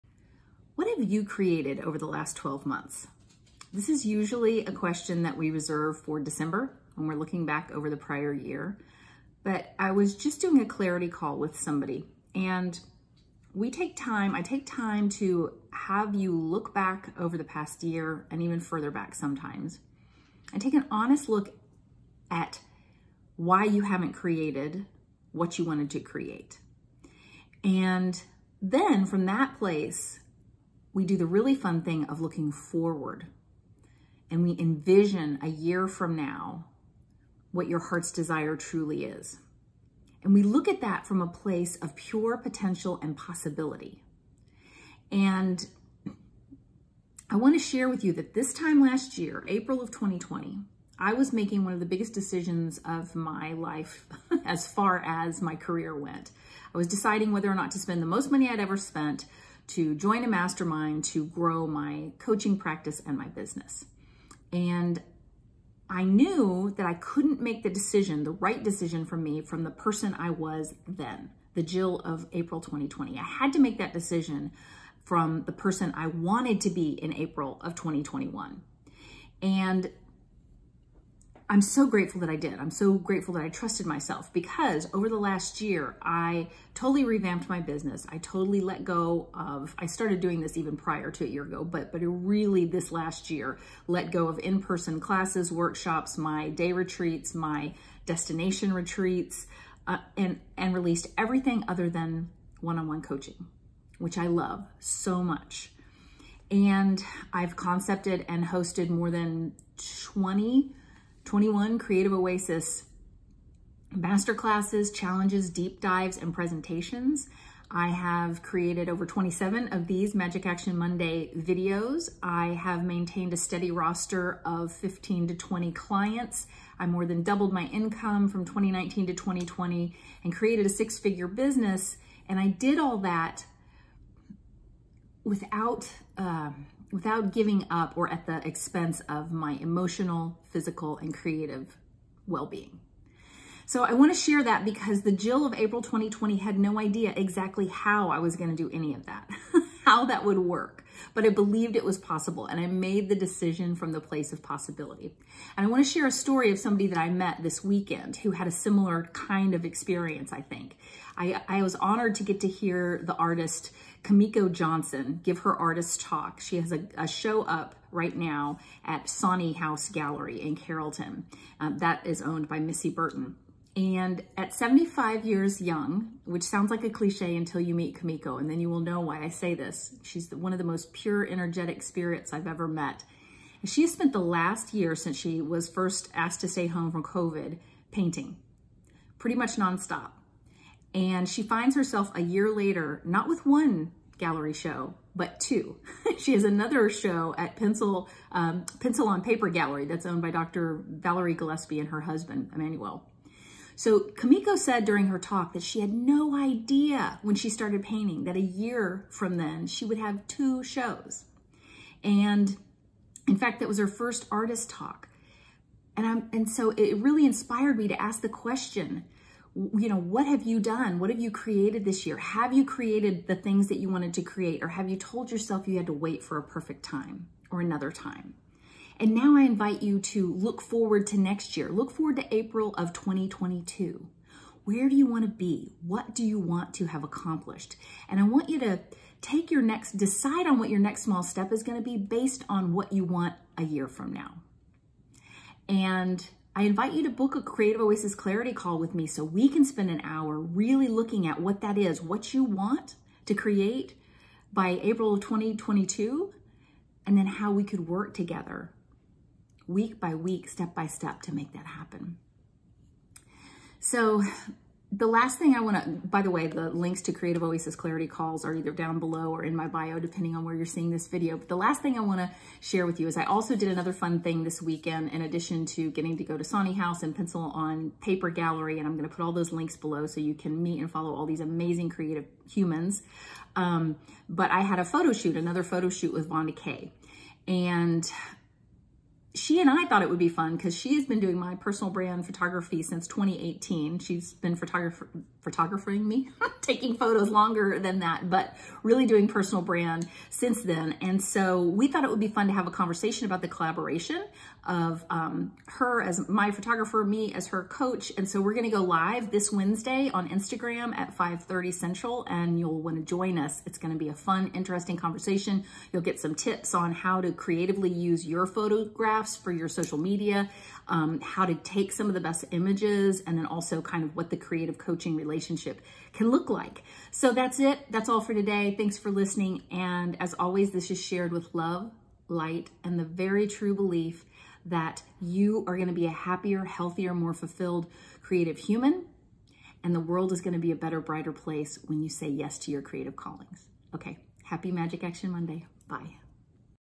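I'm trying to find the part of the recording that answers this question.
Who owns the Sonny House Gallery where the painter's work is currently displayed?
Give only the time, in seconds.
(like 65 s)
172 s.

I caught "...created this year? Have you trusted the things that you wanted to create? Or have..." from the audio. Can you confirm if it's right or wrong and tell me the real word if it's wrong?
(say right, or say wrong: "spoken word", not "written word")
wrong: "created", not "trusted".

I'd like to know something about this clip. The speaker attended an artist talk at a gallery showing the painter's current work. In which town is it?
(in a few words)
Carrollton.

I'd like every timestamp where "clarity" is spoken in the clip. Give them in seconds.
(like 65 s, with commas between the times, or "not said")
10 s, 248 s, 267 s.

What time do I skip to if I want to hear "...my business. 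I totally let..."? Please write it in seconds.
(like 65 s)
87 s.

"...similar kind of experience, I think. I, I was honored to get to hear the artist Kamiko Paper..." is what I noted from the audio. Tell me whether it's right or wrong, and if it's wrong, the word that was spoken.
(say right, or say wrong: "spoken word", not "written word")
wrong: "Johnson", not "Paper".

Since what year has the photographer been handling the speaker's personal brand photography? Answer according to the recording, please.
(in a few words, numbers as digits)
2018.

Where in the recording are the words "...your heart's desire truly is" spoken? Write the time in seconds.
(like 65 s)
37 s.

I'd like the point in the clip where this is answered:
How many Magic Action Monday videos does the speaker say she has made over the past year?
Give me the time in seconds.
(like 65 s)
118 s.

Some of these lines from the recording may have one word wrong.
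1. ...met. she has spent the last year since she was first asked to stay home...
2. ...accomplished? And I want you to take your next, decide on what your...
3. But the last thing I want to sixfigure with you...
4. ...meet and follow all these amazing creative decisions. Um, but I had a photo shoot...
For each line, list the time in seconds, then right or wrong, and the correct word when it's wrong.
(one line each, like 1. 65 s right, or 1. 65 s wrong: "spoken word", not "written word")
1. 182 s right
2. 237 s right
3. 271 s wrong: "share", not "sixfigure"
4. 280 s wrong: "humans", not "decisions".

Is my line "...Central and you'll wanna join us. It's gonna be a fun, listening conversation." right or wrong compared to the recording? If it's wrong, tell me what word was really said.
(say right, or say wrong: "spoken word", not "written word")
wrong: "interesting", not "listening".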